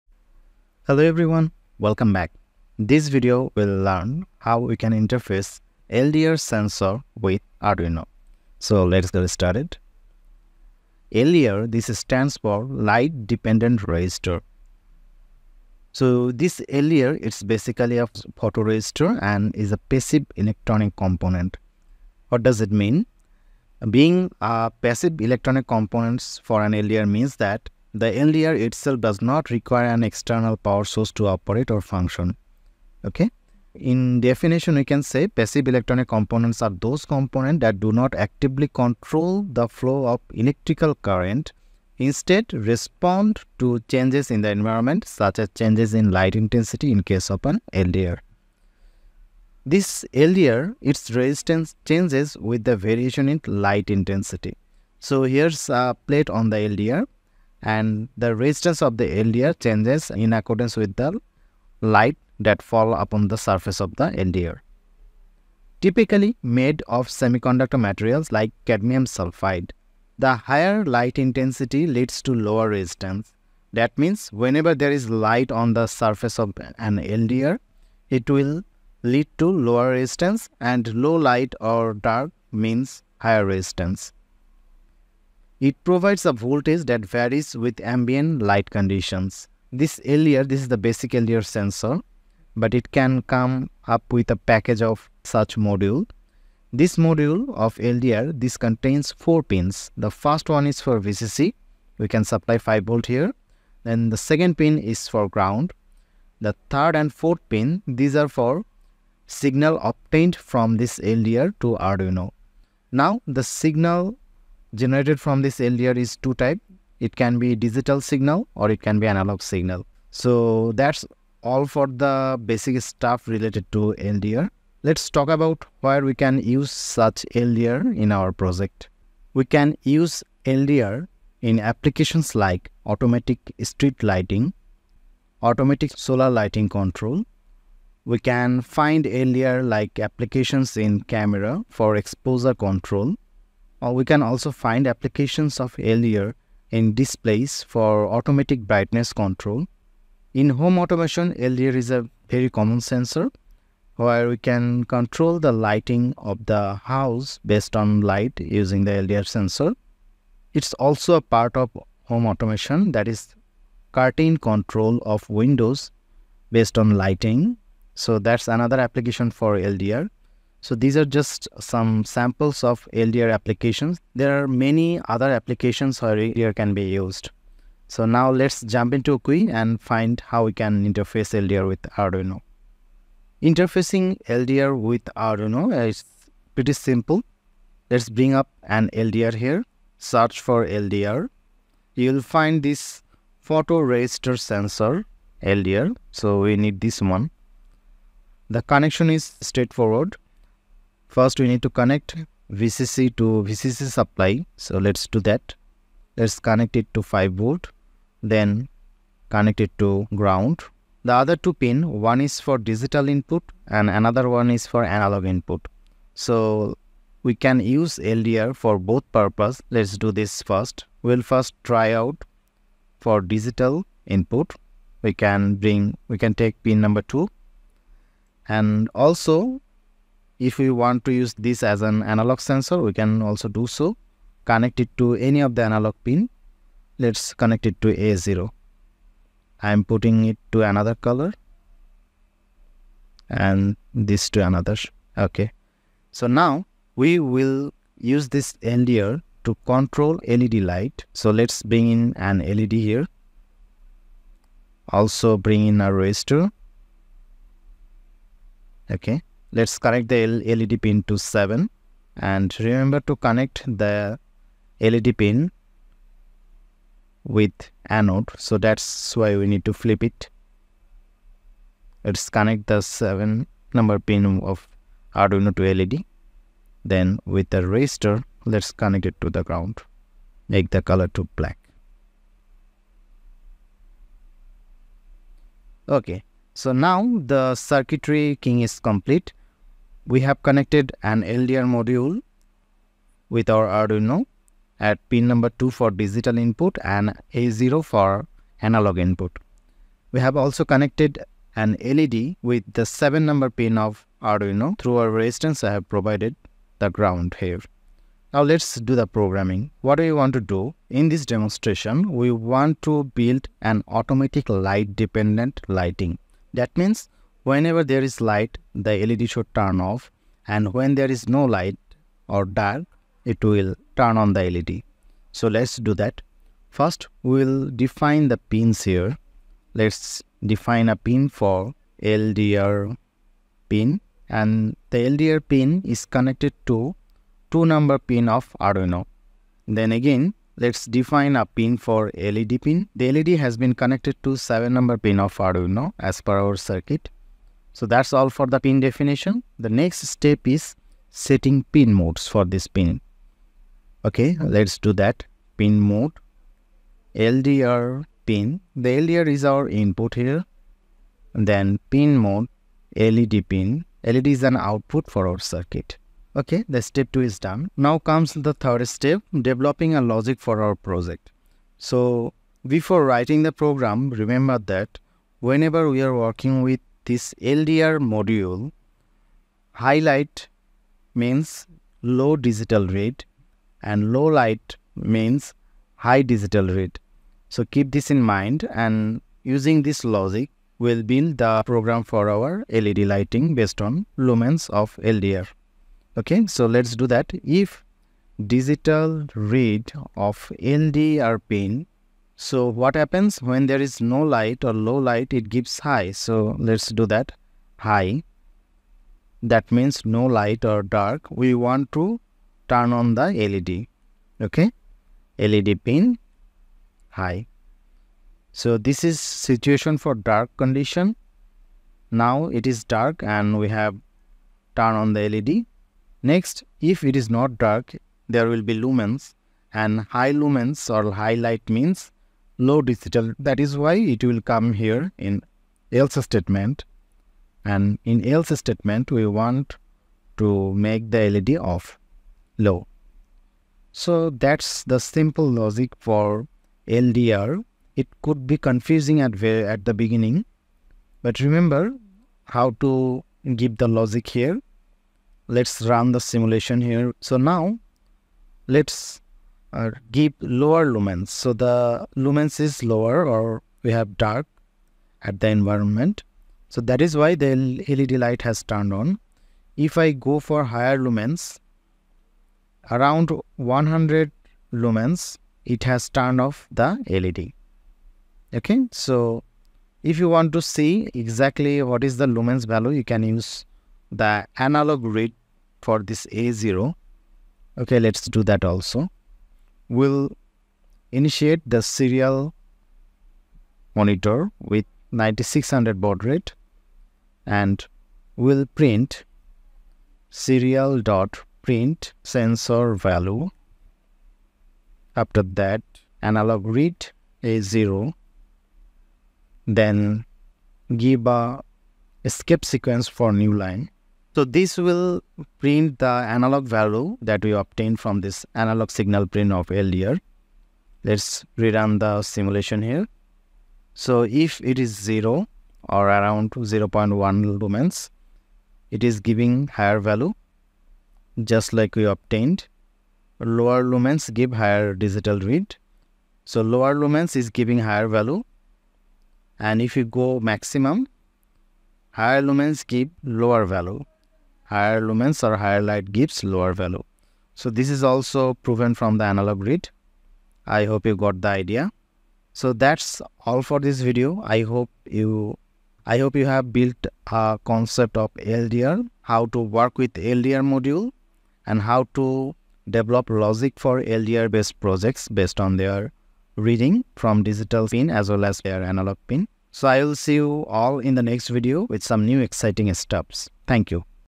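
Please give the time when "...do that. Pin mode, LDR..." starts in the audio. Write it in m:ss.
5:54.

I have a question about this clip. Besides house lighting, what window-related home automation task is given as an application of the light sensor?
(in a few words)
curtain control.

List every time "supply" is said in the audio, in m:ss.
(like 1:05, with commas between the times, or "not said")
1:42, 3:23.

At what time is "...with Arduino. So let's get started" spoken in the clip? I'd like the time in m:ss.
0:07.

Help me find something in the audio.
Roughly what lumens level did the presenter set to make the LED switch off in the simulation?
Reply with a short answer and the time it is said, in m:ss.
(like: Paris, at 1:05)
100 lumens, at 7:53.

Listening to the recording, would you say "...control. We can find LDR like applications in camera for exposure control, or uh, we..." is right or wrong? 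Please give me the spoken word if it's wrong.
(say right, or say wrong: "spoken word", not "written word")
right.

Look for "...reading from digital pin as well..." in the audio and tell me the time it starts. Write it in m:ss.
9:26.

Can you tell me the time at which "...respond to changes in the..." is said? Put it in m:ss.
0:42.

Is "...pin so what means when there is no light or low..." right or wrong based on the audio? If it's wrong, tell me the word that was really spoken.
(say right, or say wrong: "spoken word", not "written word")
wrong: "happens", not "means".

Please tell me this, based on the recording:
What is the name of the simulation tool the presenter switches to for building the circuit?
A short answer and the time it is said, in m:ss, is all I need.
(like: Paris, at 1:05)
Wokwi, at 2:59.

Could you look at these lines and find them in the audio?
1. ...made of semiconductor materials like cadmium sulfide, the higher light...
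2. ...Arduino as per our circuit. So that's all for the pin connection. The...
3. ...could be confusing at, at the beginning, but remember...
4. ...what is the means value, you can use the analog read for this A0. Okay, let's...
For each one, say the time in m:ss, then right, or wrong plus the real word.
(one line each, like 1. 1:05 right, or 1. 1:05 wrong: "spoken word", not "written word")
1. 1:06 right
2. 5:45 wrong: "definition", not "connection"
3. 7:28 right
4. 8:01 wrong: "lumens", not "means".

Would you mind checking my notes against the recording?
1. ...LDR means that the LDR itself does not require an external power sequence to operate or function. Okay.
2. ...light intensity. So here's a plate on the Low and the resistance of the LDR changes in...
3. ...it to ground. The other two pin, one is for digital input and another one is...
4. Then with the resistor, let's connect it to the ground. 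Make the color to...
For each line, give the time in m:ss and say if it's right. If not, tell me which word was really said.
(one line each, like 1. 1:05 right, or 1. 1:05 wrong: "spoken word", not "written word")
1. 0:26 wrong: "source", not "sequence"
2. 0:53 wrong: "LDR", not "Low"
3. 3:29 right
4. 4:36 right.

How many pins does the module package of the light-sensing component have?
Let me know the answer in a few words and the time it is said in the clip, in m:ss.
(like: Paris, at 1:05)
4, at 1:39.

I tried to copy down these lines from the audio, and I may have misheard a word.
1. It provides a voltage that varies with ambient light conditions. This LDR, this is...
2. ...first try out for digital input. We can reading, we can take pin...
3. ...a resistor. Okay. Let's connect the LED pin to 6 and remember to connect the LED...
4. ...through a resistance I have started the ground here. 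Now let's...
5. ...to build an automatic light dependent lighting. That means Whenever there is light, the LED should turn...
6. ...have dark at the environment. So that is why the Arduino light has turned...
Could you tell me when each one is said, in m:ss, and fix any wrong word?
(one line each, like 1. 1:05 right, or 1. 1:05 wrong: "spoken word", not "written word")
1. 1:25 right
2. 3:41 wrong: "bring", not "reading"
3. 4:15 wrong: "7", not "6"
4. 5:04 wrong: "provided", not "started"
5. 5:12 right
6. 7:43 wrong: "LED", not "Arduino".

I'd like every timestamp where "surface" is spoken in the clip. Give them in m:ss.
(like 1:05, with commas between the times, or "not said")
1:03, 1:15.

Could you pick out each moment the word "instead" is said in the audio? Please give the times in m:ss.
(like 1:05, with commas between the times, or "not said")
0:41.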